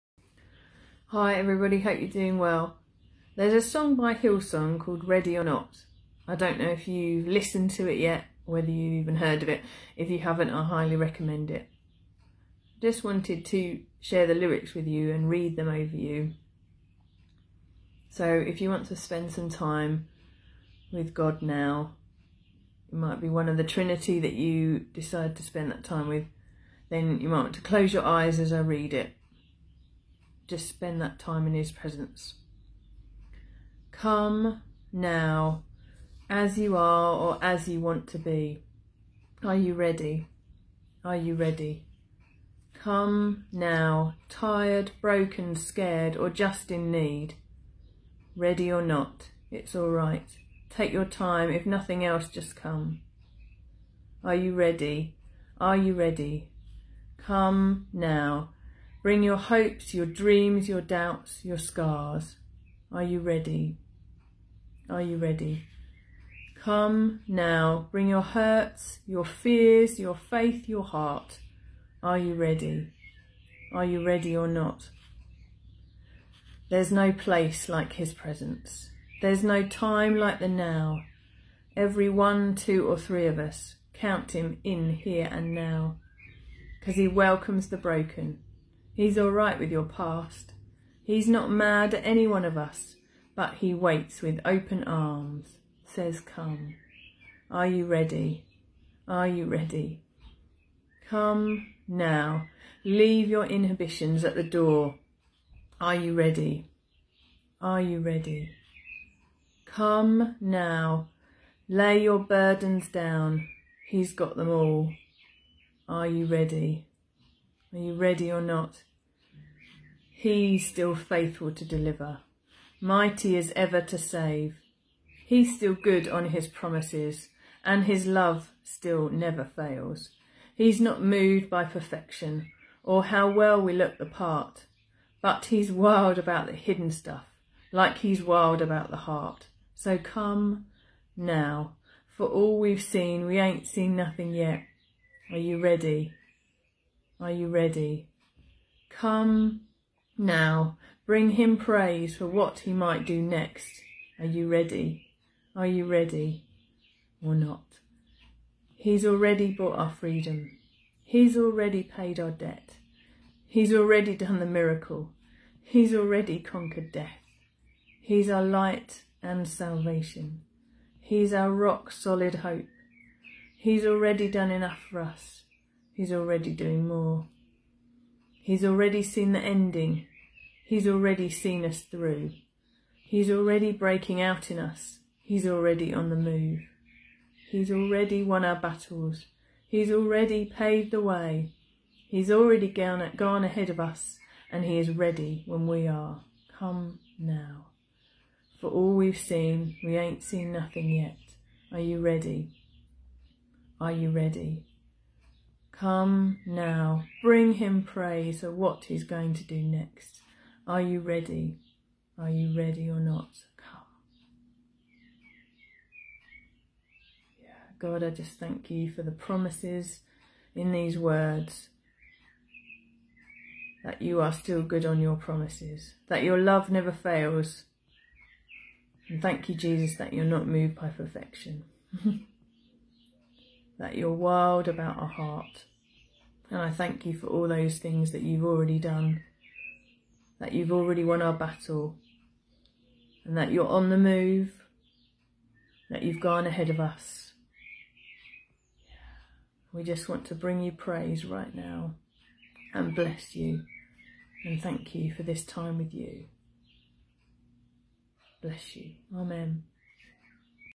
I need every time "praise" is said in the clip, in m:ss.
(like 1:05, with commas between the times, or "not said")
2:31, 3:27, 4:10.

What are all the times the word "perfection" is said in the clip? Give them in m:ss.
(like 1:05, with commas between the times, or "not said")
2:11, 3:50.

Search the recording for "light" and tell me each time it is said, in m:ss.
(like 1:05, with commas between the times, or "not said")
2:48.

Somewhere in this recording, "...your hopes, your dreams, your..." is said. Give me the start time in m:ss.
0:59.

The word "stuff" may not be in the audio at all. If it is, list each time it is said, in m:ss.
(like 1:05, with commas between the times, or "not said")
2:16.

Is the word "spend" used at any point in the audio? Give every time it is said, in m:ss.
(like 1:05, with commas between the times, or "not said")
0:18, 0:25, 0:30.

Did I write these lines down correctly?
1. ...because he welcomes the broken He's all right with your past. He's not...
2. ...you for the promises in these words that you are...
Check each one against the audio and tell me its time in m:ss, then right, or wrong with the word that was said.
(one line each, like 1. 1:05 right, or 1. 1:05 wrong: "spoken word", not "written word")
1. 1:26 right
2. 3:38 right.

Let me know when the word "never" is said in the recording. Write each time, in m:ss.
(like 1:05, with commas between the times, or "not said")
2:09, 3:46.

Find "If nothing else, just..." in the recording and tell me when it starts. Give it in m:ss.
0:51.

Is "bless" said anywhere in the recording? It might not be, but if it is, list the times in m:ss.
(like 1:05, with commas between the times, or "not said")
4:12, 4:18.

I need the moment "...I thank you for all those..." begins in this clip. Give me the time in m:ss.
3:56.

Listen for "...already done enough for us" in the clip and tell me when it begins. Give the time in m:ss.
2:53.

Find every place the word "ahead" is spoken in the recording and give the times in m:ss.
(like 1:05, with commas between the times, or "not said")
3:13, 4:06.